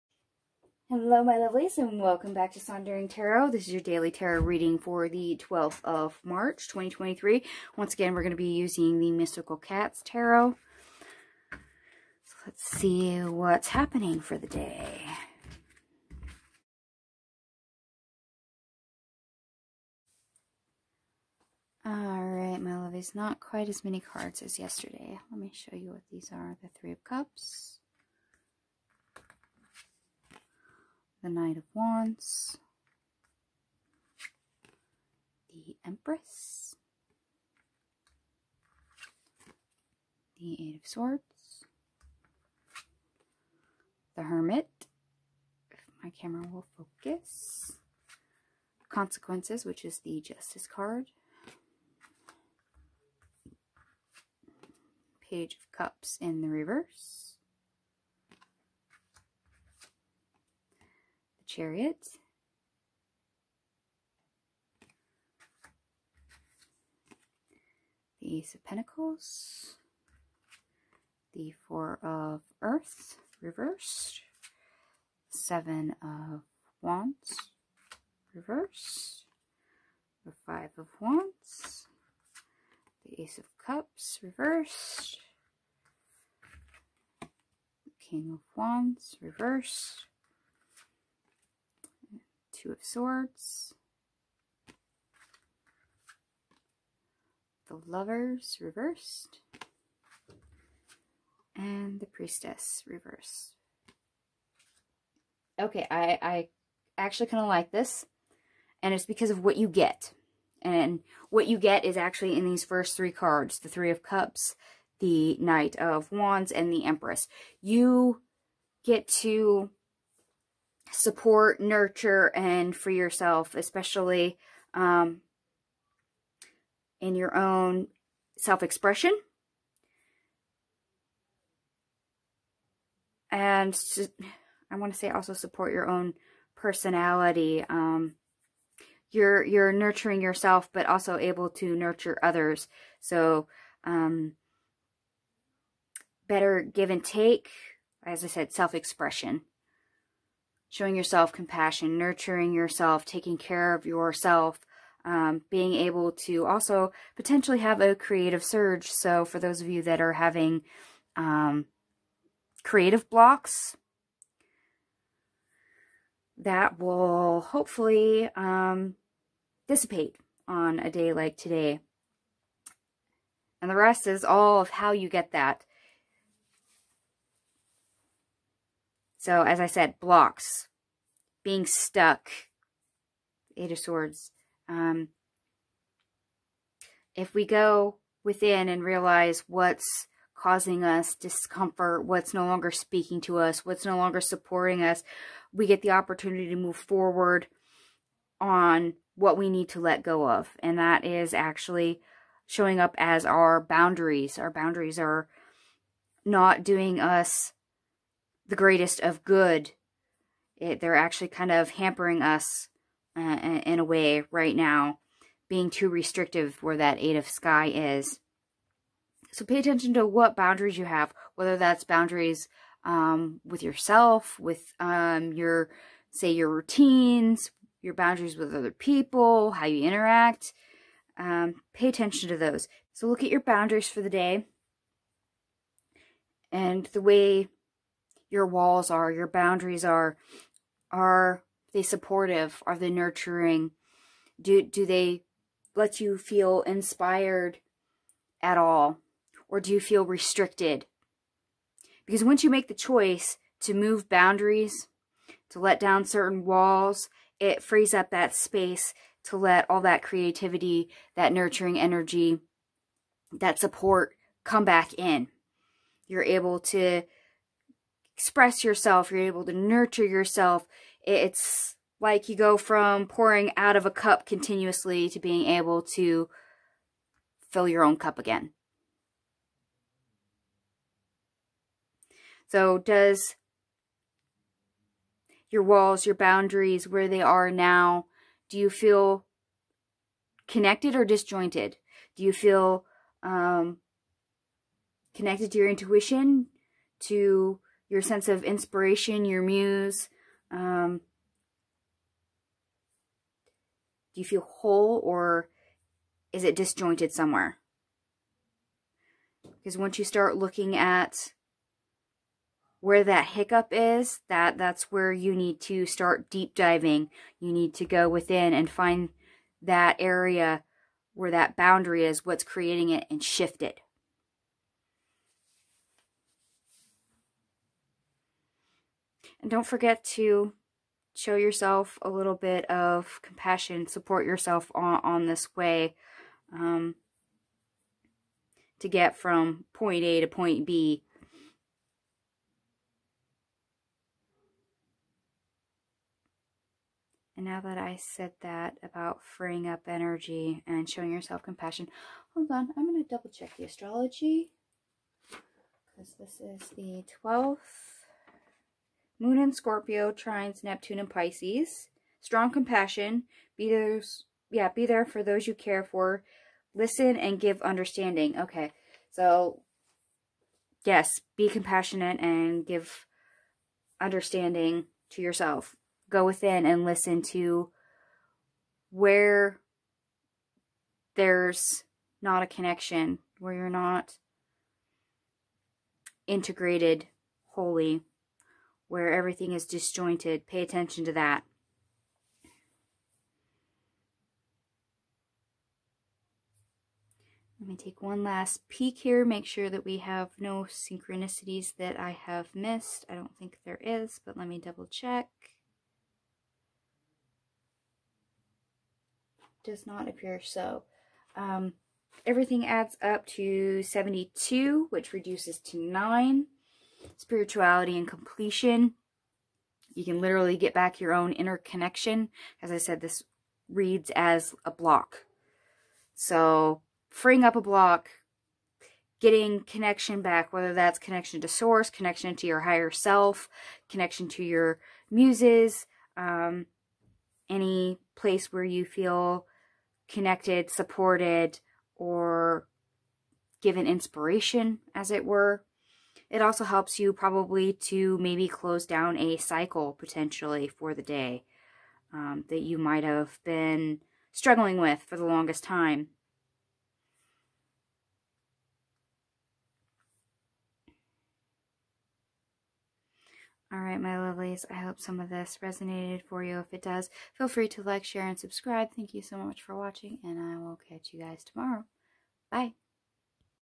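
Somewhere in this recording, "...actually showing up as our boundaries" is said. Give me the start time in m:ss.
3:21.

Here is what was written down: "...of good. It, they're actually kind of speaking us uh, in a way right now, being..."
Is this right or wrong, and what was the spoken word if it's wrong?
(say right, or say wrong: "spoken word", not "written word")
wrong: "hampering", not "speaking".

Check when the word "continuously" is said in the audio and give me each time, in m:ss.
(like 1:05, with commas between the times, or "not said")
4:34.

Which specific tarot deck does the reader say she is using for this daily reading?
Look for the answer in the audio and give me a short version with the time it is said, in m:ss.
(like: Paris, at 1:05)
Mystical Cats Tarot, at 0:09.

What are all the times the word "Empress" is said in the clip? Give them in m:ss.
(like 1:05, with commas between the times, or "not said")
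0:35, 1:56.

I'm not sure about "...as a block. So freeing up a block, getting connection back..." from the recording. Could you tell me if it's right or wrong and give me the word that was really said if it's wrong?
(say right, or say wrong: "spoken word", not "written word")
right.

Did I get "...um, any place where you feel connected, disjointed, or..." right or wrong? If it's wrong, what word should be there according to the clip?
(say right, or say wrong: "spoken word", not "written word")
wrong: "supported", not "disjointed".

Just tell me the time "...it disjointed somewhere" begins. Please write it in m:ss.
5:06.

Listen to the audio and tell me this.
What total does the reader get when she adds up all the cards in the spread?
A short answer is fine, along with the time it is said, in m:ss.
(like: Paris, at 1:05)
72, at 6:53.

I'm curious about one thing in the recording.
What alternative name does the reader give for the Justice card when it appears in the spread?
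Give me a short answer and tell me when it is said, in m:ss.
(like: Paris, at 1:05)
Consequences, at 0:48.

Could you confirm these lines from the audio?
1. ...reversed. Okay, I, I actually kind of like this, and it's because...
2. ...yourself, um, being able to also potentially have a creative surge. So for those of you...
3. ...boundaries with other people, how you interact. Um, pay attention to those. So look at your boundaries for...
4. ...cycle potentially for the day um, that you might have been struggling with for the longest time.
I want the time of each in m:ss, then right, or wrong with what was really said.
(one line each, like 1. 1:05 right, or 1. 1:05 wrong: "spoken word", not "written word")
1. 1:42 right
2. 2:33 right
3. 3:47 right
4. 7:29 right.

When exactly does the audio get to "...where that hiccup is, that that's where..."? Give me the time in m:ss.
5:12.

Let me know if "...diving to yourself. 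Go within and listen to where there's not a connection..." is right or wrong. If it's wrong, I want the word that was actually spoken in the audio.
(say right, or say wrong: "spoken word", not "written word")
wrong: "understanding", not "diving".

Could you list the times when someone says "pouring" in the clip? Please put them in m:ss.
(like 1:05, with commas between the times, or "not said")
4:33.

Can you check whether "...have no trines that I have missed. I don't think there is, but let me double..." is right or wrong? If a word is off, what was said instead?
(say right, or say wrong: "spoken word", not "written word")
wrong: "synchronicities", not "trines".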